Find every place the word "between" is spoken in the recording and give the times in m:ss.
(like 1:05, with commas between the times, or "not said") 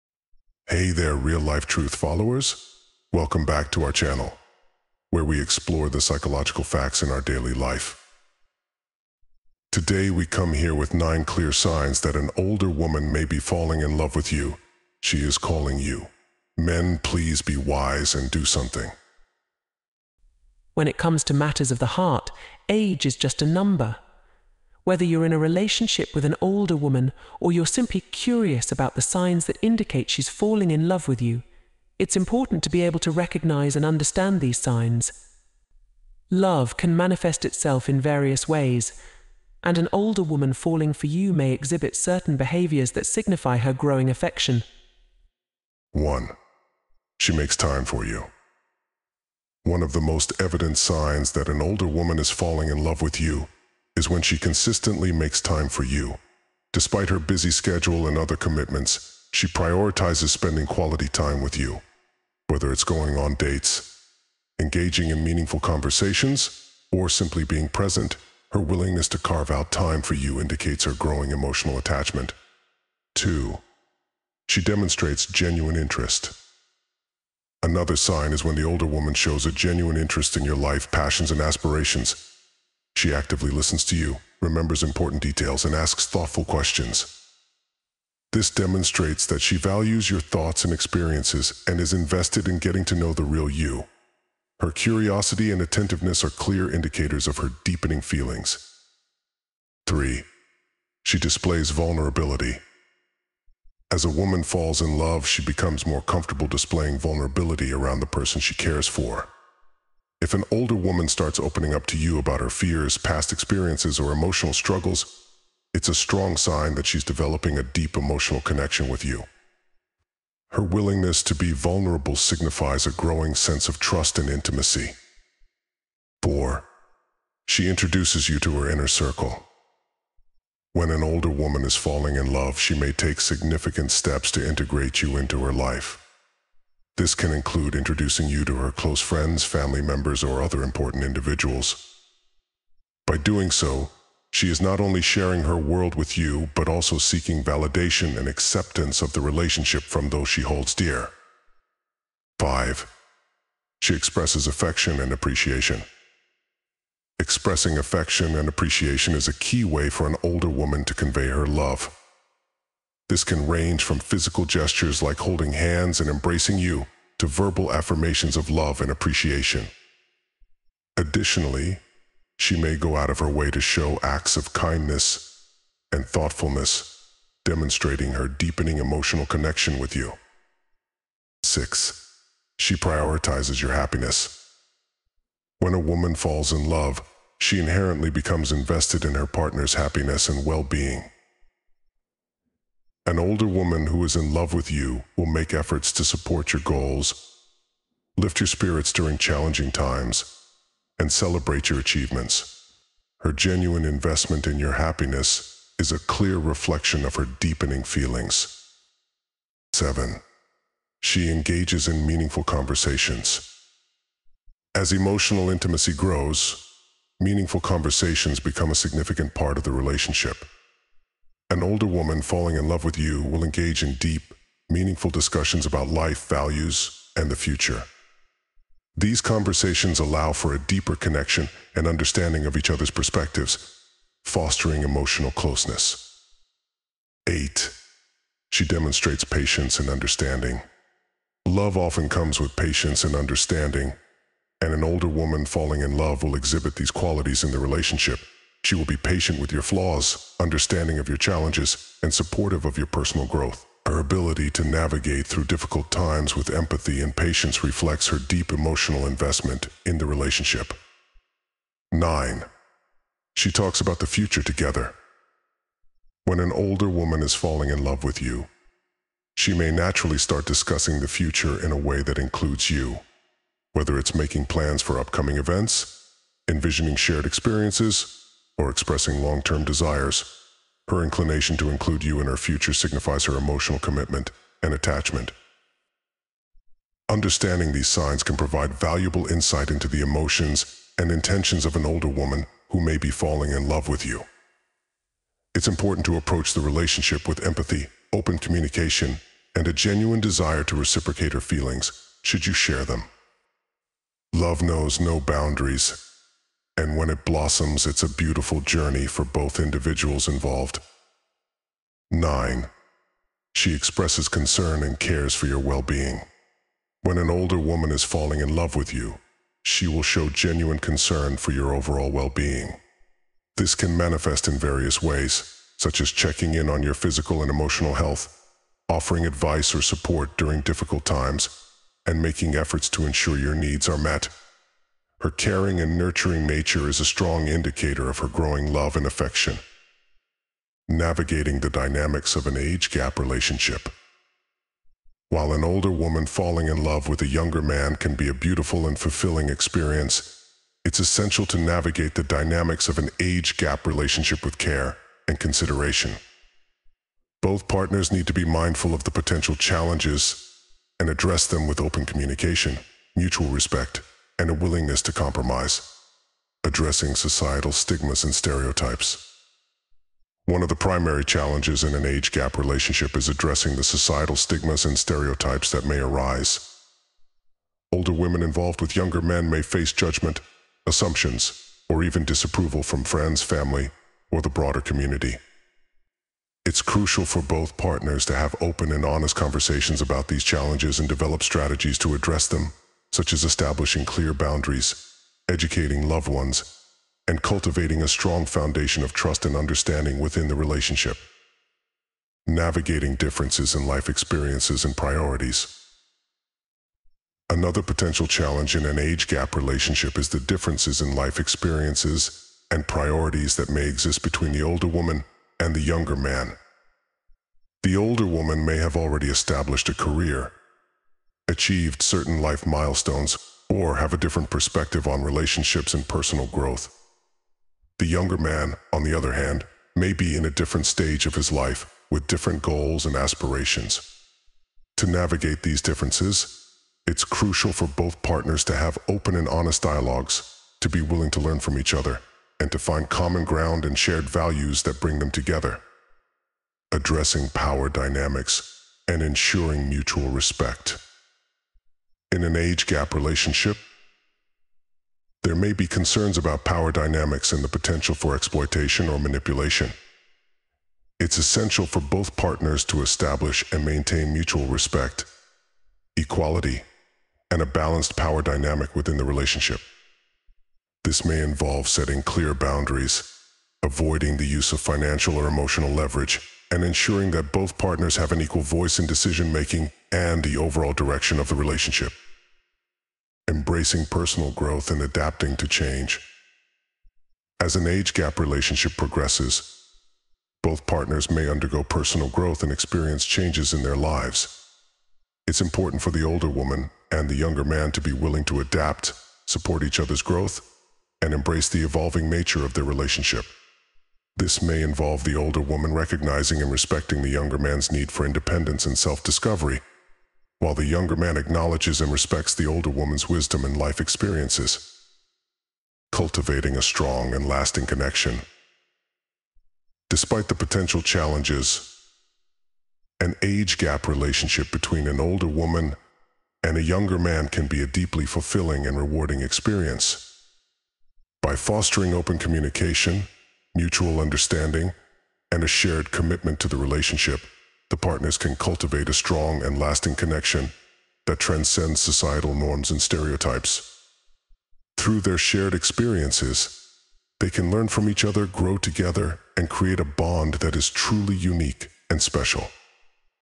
6:54, 8:44.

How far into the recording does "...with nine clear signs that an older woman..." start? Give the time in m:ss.
0:10.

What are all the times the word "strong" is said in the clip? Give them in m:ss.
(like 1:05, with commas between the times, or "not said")
1:55, 5:37, 6:38, 8:36, 8:59.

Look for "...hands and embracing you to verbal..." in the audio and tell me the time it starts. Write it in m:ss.
2:45.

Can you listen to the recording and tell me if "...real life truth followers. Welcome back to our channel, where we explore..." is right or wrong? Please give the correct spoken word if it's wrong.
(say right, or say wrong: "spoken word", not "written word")
right.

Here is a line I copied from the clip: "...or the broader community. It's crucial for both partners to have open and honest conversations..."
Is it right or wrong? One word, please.
right.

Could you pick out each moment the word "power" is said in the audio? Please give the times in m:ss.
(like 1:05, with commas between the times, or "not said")
7:27, 7:36, 7:48.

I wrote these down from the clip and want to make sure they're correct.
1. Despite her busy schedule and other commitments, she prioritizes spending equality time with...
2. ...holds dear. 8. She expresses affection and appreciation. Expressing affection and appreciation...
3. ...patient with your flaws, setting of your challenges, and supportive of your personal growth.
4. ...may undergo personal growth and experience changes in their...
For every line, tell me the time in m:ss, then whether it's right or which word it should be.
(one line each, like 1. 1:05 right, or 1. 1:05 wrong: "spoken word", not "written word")
1. 0:56 wrong: "quality", not "equality"
2. 2:30 wrong: "5", not "8"
3. 4:08 wrong: "understanding", not "setting"
4. 8:11 right.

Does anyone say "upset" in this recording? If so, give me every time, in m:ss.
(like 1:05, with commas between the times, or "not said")
not said.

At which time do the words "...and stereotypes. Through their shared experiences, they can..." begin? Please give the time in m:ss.
9:02.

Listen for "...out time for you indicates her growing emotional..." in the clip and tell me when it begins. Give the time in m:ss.
1:09.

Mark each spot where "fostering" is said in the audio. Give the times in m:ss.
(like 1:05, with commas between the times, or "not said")
3:54, 8:51.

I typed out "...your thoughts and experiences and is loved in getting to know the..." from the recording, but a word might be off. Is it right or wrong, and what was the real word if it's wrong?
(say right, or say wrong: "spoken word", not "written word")
wrong: "invested", not "loved".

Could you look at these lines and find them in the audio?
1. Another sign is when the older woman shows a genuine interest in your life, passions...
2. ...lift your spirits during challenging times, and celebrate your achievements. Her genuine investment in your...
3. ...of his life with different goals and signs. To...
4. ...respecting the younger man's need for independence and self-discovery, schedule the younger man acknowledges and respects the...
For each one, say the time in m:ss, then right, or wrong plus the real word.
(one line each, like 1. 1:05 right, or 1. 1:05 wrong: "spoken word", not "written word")
1. 1:17 right
2. 3:18 right
3. 7:11 wrong: "aspirations", not "signs"
4. 8:26 wrong: "while", not "schedule".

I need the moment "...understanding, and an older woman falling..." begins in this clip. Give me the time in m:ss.
4:03.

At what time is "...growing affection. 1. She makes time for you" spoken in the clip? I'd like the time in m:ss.
0:43.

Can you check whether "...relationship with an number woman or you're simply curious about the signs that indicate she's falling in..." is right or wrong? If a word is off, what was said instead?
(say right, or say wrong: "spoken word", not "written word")
wrong: "older", not "number".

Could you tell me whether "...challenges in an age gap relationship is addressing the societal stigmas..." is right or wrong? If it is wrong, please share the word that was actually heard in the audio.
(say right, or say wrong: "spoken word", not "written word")
right.